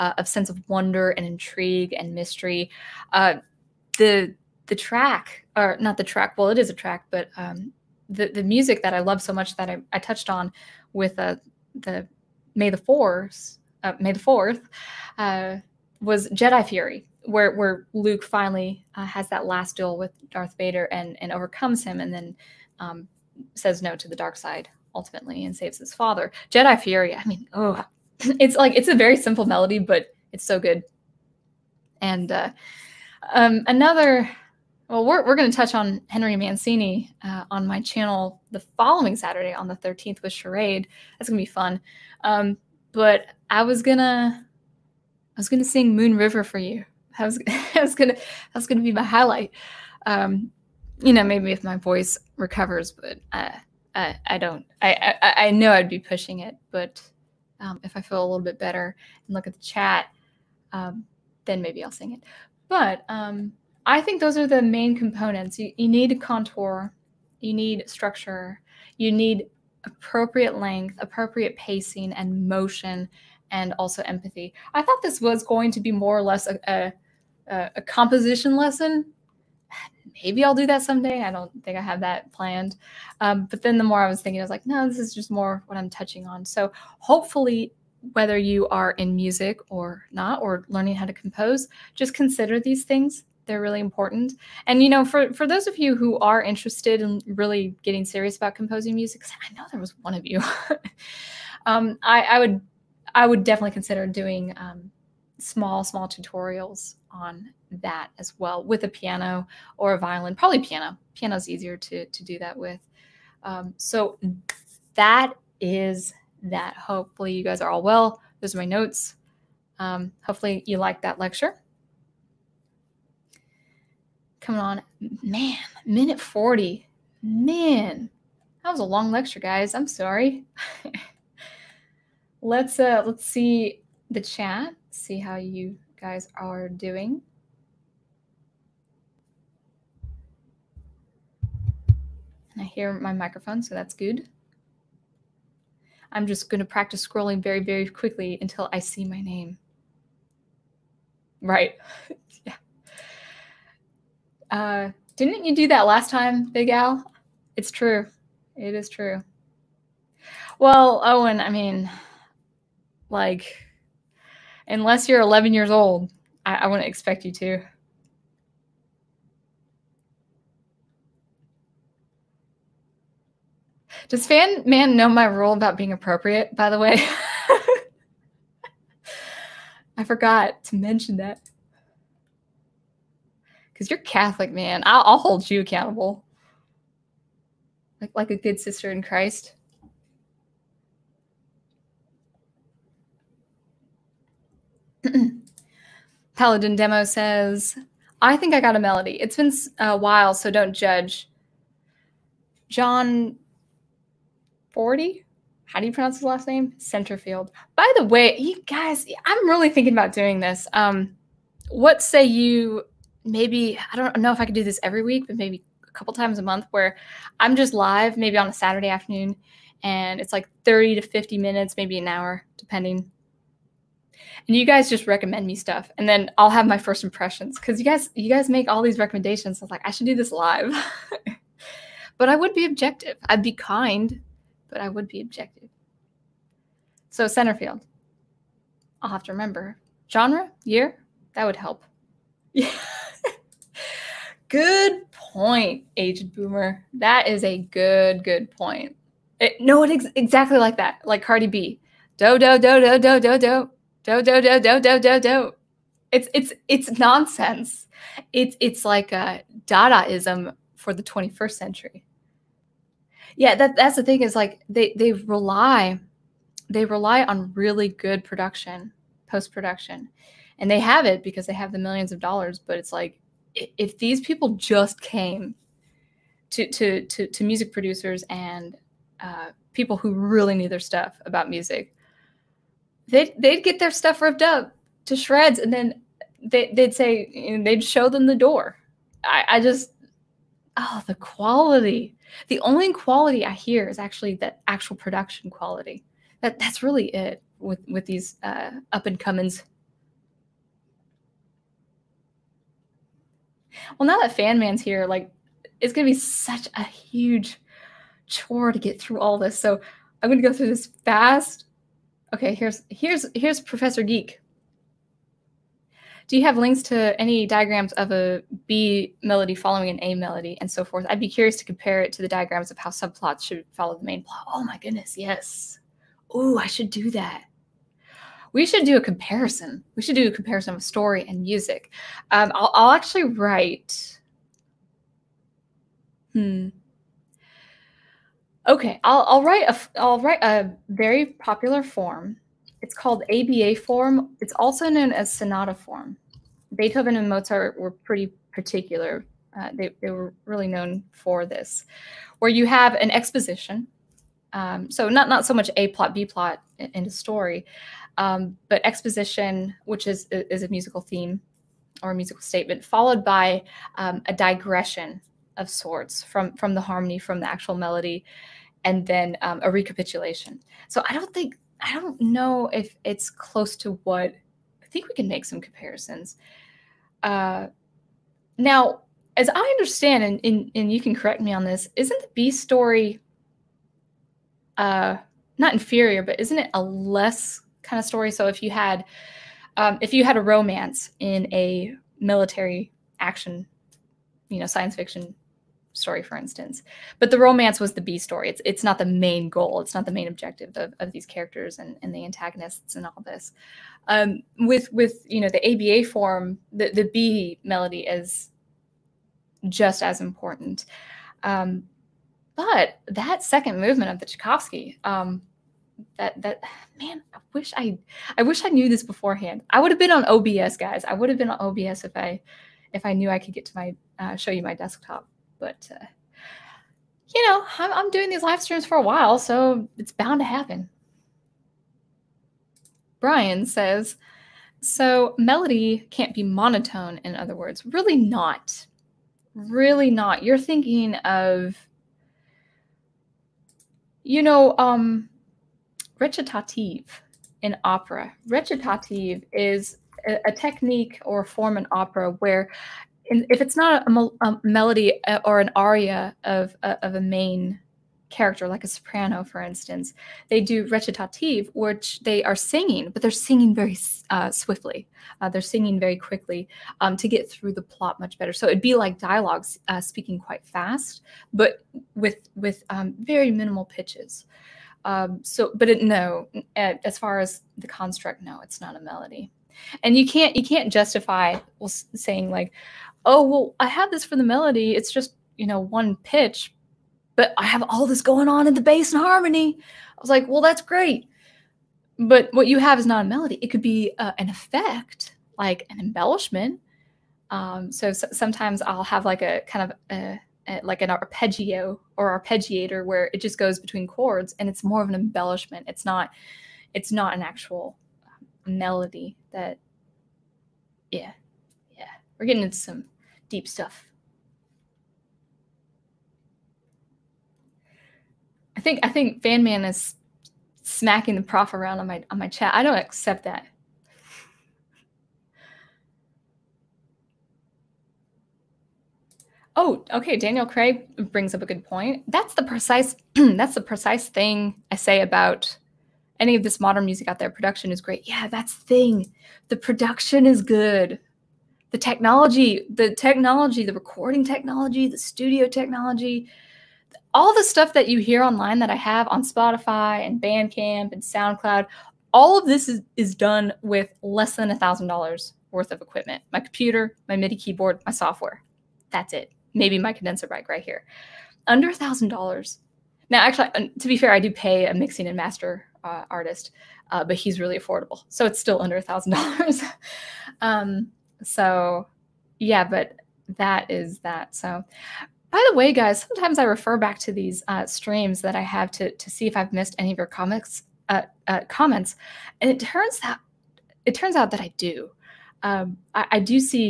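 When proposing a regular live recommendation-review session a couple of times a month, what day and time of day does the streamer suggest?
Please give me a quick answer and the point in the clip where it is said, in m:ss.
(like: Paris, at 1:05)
Saturday afternoon, at 3:38.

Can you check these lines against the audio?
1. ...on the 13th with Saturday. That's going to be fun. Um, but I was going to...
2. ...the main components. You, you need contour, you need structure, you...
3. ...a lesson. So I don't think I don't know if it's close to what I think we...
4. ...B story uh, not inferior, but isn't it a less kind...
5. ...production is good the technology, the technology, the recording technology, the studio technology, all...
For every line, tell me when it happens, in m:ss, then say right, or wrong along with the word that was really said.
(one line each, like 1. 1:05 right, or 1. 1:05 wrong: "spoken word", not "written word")
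1. 0:39 wrong: "Charade", not "Saturday"
2. 1:04 right
3. 6:09 wrong: "recapitulation", not "lesson"
4. 6:22 right
5. 8:59 right.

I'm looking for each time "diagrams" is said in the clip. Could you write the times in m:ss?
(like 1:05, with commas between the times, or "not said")
5:17, 5:22.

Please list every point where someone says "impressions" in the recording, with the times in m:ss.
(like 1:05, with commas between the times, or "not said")
3:47.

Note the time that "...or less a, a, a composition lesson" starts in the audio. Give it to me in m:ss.
1:16.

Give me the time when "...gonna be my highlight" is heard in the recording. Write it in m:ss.
0:48.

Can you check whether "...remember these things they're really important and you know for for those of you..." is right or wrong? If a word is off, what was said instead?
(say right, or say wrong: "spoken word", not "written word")
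wrong: "consider", not "remember".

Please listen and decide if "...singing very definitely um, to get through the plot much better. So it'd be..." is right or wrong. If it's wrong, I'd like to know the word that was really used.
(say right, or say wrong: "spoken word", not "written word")
wrong: "quickly", not "definitely".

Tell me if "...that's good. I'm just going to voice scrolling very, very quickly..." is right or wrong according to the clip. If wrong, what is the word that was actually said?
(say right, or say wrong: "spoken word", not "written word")
wrong: "practice", not "voice".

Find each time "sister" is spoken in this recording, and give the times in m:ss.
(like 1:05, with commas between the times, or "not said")
3:08.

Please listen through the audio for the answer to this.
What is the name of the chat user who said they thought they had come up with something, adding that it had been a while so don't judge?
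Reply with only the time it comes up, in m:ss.
3:16.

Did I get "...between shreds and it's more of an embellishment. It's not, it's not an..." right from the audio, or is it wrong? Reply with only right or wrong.
wrong.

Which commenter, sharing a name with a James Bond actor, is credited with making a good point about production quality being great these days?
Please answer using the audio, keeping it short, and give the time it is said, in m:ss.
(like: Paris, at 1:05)
Daniel Craig, at 8:50.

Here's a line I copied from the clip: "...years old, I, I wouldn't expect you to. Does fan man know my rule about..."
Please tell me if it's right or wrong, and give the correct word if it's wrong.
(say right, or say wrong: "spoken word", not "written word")
right.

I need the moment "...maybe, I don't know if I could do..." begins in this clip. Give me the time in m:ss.
3:33.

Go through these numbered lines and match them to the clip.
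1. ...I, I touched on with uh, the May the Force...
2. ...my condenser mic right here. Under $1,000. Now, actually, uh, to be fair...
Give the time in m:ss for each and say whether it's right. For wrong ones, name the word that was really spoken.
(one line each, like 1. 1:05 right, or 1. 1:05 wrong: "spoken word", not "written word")
1. 0:09 right
2. 9:19 right.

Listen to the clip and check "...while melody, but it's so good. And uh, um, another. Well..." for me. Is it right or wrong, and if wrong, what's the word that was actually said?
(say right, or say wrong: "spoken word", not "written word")
wrong: "simple", not "while".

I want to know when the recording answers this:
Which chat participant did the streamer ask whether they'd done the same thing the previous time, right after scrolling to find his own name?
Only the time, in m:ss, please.
2:36.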